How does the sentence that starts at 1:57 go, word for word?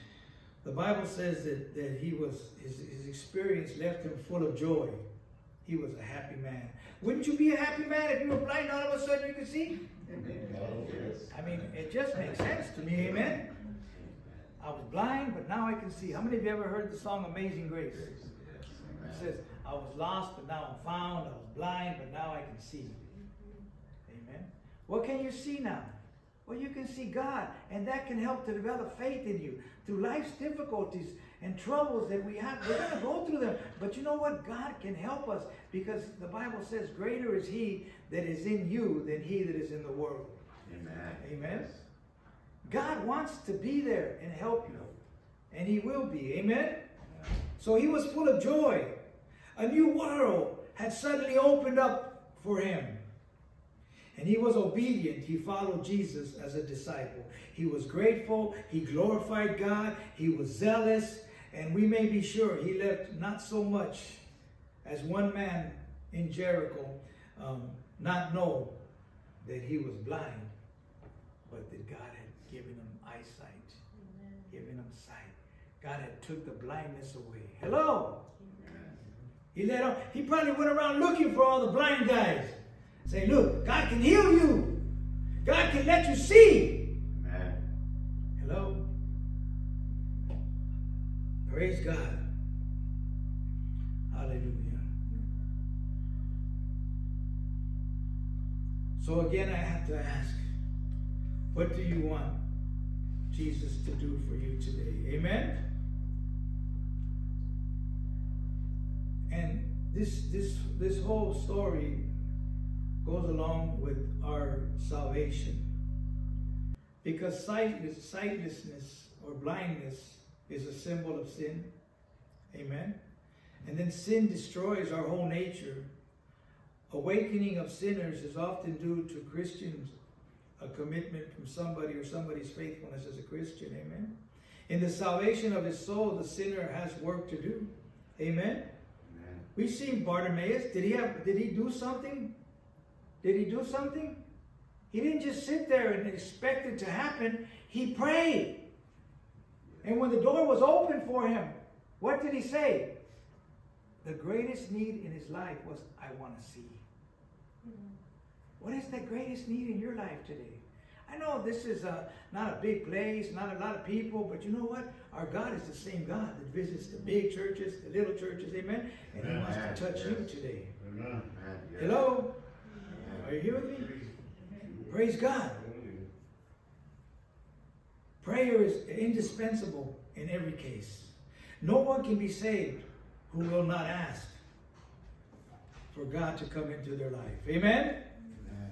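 Because sightless, sightlessness or blindness is a symbol of sin.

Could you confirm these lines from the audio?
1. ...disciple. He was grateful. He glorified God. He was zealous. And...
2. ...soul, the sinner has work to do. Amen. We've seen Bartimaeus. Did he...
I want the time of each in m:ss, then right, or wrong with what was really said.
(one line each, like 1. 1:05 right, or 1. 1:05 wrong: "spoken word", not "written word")
1. 0:56 right
2. 2:15 right.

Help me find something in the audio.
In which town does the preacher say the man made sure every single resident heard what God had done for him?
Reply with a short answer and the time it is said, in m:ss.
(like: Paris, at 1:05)
Jericho, at 1:06.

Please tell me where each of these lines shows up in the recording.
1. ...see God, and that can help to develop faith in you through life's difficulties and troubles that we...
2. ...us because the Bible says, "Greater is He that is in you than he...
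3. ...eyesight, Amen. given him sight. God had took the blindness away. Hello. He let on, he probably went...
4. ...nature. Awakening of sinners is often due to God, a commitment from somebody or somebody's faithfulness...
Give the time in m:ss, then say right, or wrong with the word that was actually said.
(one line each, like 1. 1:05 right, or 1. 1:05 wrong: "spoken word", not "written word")
1. 0:26 right
2. 0:35 right
3. 1:13 right
4. 2:05 wrong: "Christians", not "God".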